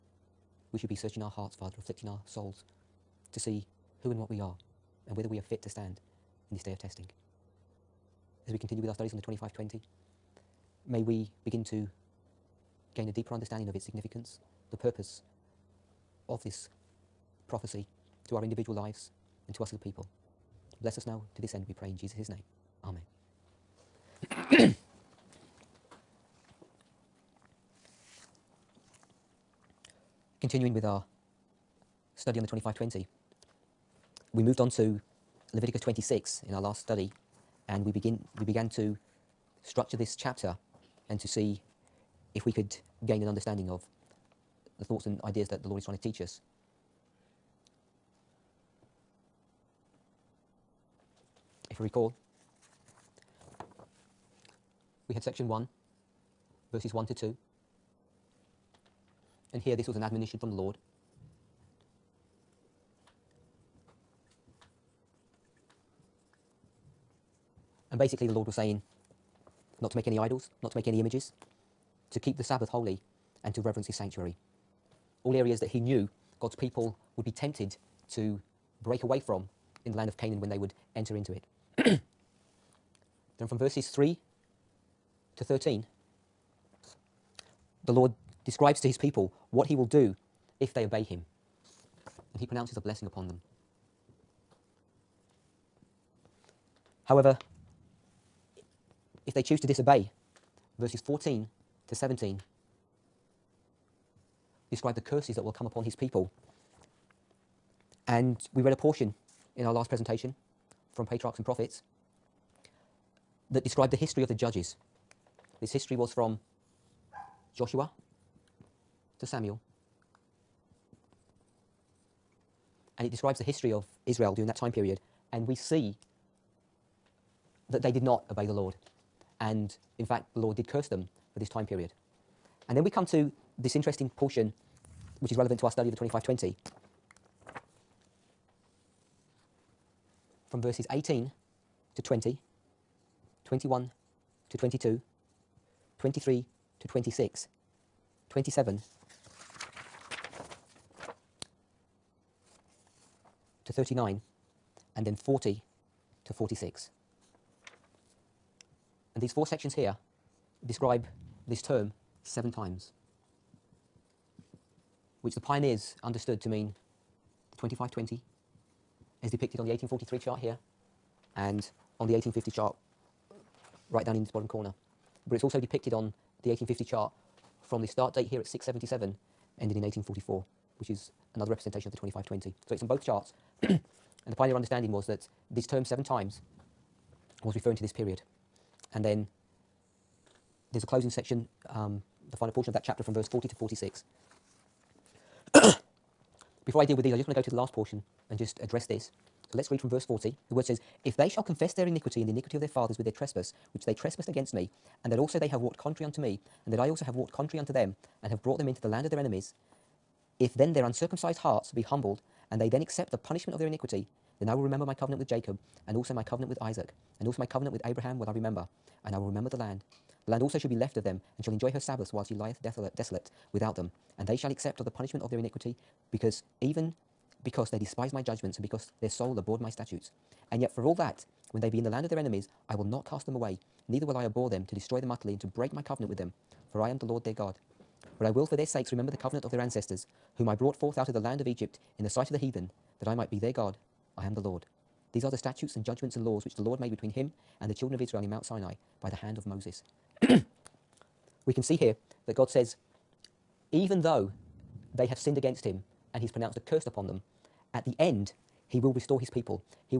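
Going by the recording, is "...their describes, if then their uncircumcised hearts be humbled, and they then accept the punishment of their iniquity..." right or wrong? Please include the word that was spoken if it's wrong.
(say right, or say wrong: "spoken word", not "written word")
wrong: "enemies", not "describes".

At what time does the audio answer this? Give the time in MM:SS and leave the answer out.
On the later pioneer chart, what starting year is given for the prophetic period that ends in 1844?
02:58.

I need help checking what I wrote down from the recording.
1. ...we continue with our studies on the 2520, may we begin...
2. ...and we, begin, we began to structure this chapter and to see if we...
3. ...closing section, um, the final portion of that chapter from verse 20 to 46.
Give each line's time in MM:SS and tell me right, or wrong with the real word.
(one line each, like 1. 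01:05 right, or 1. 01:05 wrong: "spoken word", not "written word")
1. 00:08 right
2. 00:37 right
3. 03:10 wrong: "40", not "20".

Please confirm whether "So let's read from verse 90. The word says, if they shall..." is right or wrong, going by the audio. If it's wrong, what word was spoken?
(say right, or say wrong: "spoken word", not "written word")
wrong: "40", not "90".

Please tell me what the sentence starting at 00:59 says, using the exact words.
And here this was an admonition from the Lord.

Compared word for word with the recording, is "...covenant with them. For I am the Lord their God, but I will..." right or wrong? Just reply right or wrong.
right.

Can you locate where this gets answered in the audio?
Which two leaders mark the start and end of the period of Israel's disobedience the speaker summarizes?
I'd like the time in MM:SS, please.
01:57.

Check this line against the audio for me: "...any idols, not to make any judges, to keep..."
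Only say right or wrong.
wrong.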